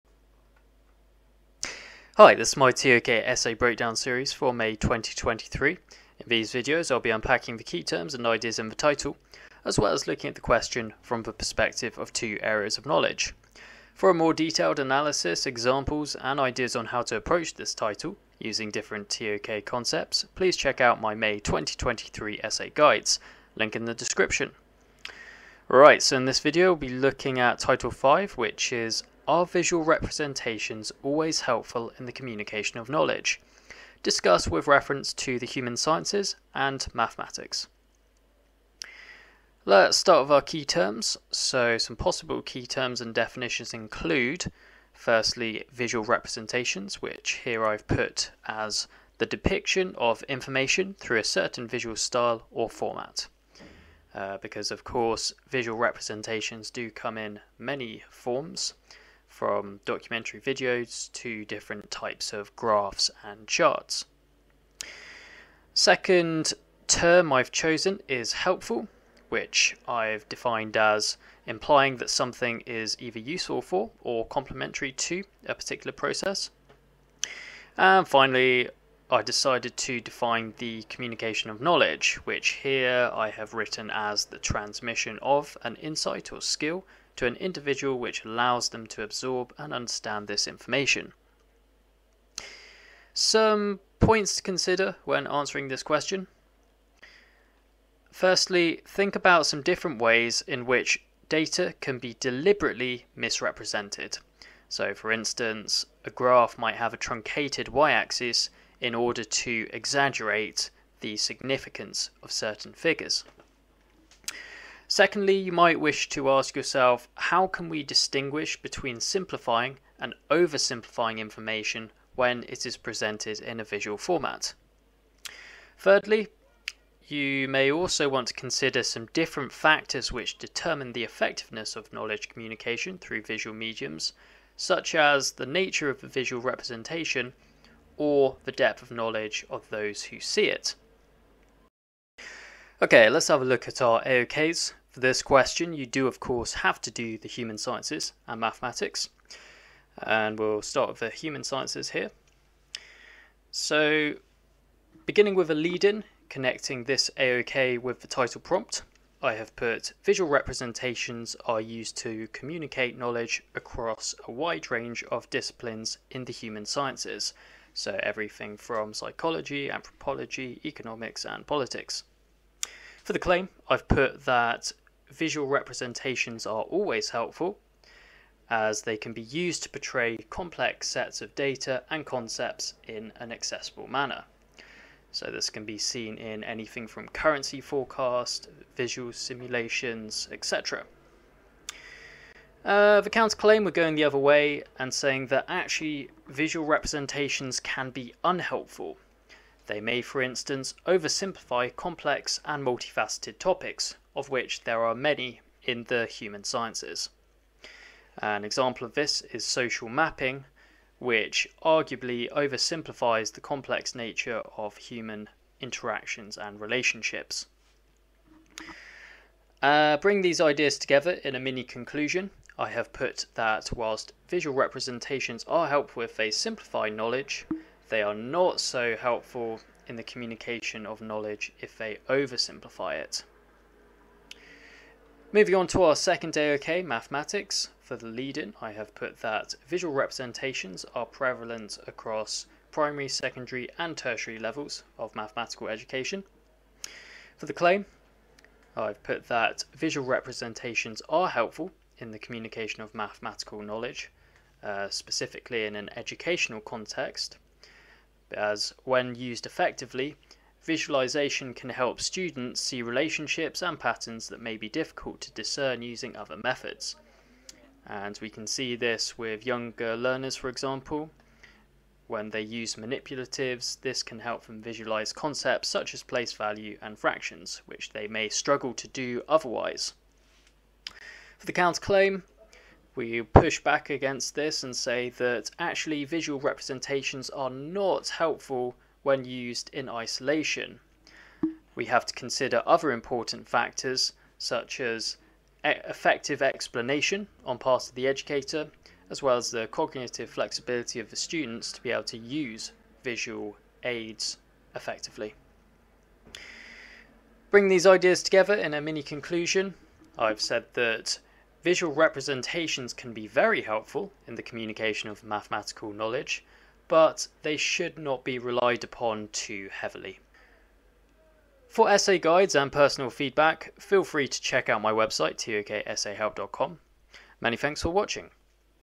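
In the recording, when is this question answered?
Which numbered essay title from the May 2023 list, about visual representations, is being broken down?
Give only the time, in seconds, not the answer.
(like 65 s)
27 s.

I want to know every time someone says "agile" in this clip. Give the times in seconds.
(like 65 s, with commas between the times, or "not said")
not said.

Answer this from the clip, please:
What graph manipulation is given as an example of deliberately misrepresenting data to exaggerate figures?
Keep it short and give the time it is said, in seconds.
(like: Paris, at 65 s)
truncated y axis, at 106 s.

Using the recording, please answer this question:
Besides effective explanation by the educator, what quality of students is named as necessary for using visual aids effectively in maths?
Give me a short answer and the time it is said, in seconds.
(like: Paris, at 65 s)
cognitive flexibility, at 299 s.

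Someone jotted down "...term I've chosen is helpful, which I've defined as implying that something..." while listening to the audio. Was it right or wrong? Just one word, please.
right.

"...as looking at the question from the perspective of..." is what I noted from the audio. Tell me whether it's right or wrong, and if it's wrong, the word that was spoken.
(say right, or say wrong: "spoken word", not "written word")
right.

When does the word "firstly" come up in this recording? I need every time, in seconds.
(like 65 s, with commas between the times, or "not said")
44 s, 98 s.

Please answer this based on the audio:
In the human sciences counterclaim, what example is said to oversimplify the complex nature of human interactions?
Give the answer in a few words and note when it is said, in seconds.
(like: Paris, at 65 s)
social mapping, at 209 s.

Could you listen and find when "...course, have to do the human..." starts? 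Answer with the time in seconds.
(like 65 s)
146 s.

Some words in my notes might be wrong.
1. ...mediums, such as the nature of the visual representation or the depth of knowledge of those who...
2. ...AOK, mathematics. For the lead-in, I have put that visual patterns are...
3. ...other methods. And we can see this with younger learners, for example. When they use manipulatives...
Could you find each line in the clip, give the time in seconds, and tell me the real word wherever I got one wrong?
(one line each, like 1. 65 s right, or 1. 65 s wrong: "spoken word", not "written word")
1. 133 s right
2. 236 s wrong: "representations", not "patterns"
3. 266 s right.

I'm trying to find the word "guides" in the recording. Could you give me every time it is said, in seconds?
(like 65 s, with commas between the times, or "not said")
22 s, 322 s.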